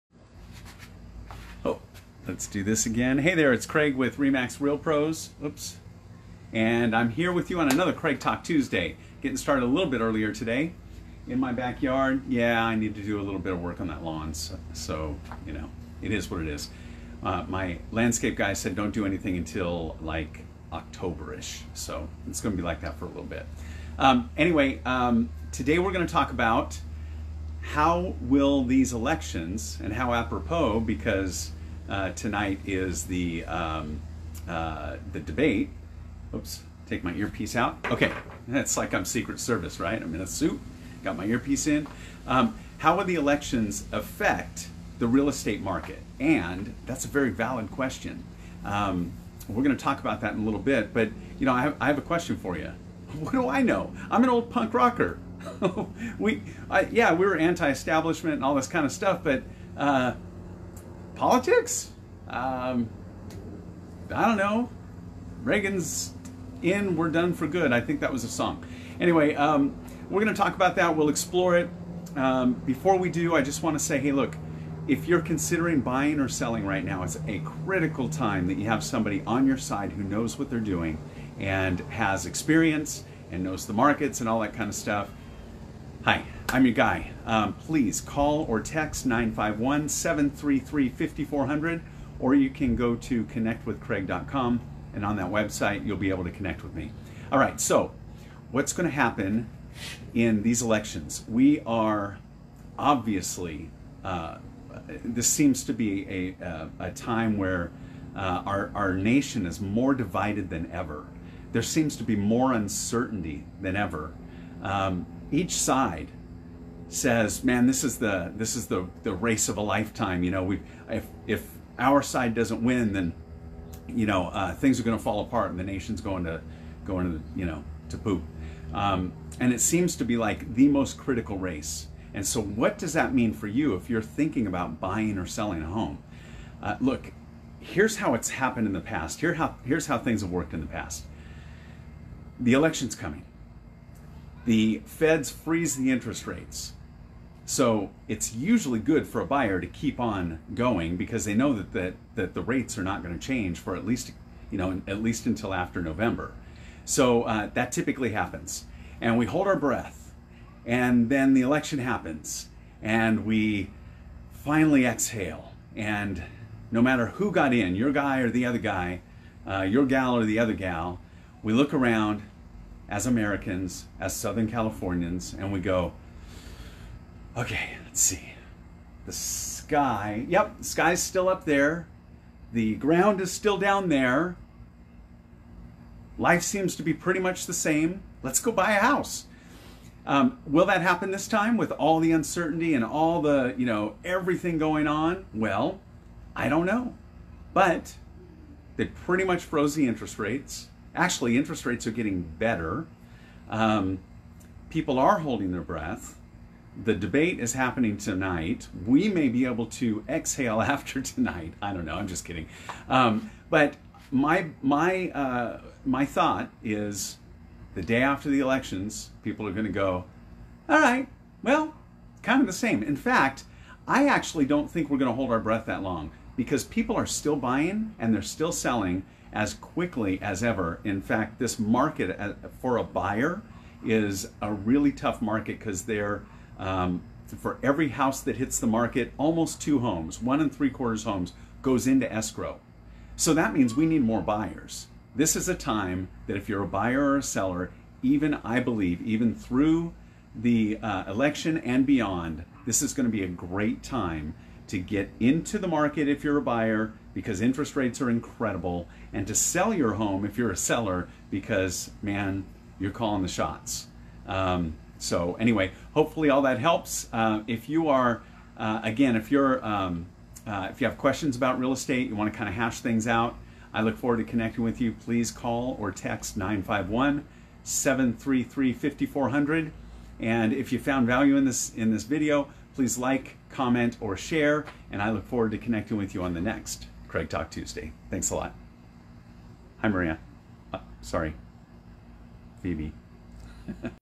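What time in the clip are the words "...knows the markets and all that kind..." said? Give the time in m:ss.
1:23.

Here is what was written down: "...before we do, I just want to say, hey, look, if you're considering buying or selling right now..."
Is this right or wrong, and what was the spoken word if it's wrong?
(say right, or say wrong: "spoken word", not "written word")
right.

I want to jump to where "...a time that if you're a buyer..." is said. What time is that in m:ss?
4:05.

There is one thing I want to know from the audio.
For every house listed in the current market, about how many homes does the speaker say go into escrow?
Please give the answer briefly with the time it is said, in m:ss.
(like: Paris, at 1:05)
1.75, at 4:00.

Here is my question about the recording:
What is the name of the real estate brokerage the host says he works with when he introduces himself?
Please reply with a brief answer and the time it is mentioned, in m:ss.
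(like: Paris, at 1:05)
Remax Real Pros, at 0:04.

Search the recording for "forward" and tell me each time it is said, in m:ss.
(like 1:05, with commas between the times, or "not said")
4:33, 4:45.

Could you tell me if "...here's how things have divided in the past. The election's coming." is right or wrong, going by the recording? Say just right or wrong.
wrong.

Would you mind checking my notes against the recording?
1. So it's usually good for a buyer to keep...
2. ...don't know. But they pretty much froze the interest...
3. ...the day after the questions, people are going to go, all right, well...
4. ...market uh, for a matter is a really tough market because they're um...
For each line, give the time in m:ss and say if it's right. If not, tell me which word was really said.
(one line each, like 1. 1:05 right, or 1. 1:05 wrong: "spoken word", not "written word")
1. 2:27 right
2. 3:16 right
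3. 3:37 wrong: "elections", not "questions"
4. 3:51 wrong: "buyer", not "matter".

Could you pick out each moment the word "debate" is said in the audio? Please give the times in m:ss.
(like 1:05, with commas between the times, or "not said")
0:35, 3:26.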